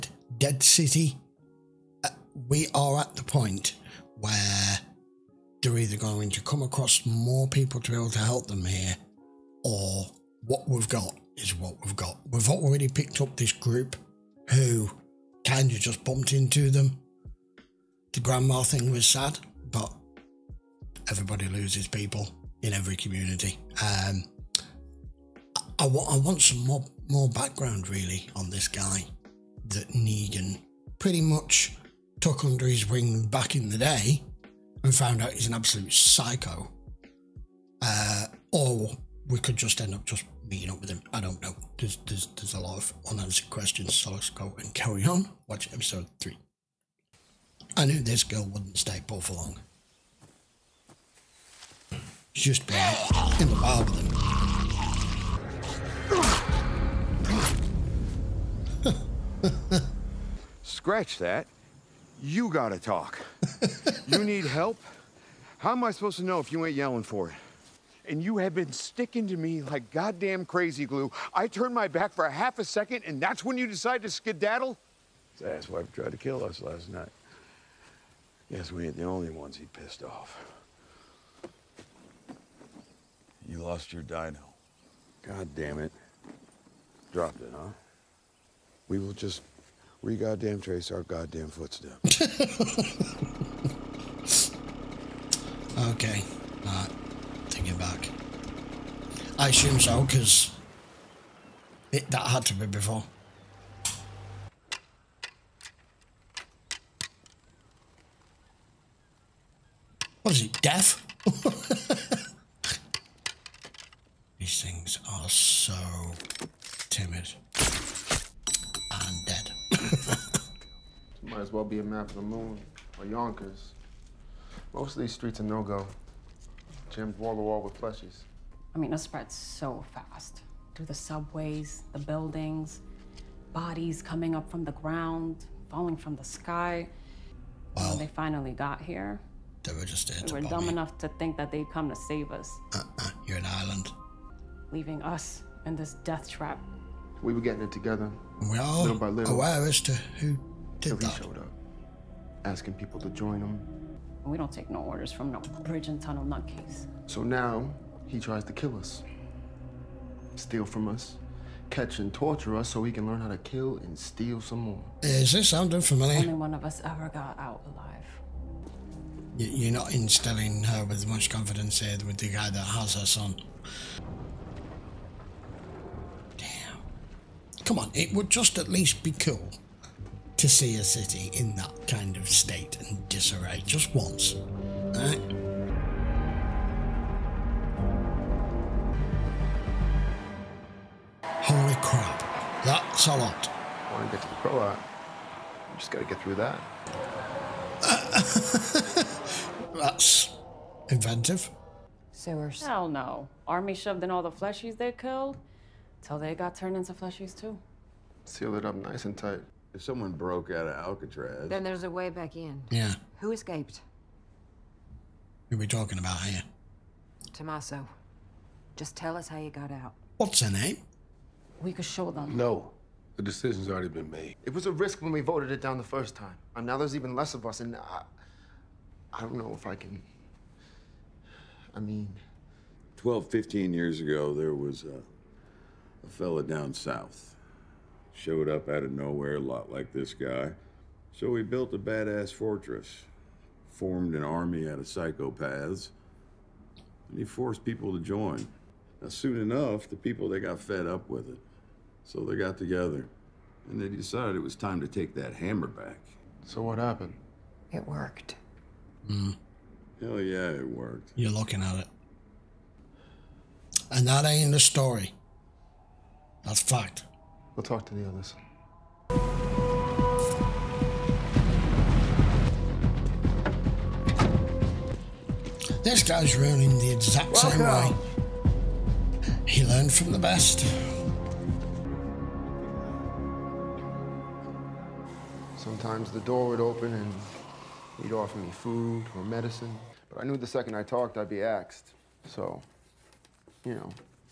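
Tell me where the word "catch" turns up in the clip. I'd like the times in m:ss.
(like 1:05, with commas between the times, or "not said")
2:41.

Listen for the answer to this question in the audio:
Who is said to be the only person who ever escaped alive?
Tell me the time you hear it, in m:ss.
3:37.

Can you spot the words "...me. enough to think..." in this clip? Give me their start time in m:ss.
2:20.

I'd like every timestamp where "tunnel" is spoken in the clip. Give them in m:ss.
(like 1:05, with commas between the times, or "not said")
2:36.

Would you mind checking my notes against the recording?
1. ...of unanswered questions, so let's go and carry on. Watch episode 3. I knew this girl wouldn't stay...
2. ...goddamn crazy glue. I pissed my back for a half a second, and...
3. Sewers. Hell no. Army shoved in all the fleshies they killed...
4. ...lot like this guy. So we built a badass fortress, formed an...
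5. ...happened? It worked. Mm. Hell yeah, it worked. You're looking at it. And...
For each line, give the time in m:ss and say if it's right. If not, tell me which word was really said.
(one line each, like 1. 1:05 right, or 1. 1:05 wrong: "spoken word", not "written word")
1. 0:42 right
2. 1:09 wrong: "turned", not "pissed"
3. 3:22 right
4. 3:59 right
5. 4:16 right.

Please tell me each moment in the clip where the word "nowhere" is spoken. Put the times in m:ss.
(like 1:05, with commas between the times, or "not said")
3:58.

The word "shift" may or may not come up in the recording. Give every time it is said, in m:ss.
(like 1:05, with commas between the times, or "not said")
not said.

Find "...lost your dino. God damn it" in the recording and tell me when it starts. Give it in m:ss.
1:23.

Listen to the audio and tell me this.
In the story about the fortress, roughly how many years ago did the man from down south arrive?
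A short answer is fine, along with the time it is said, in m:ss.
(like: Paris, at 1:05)
12 to 15 years, at 3:52.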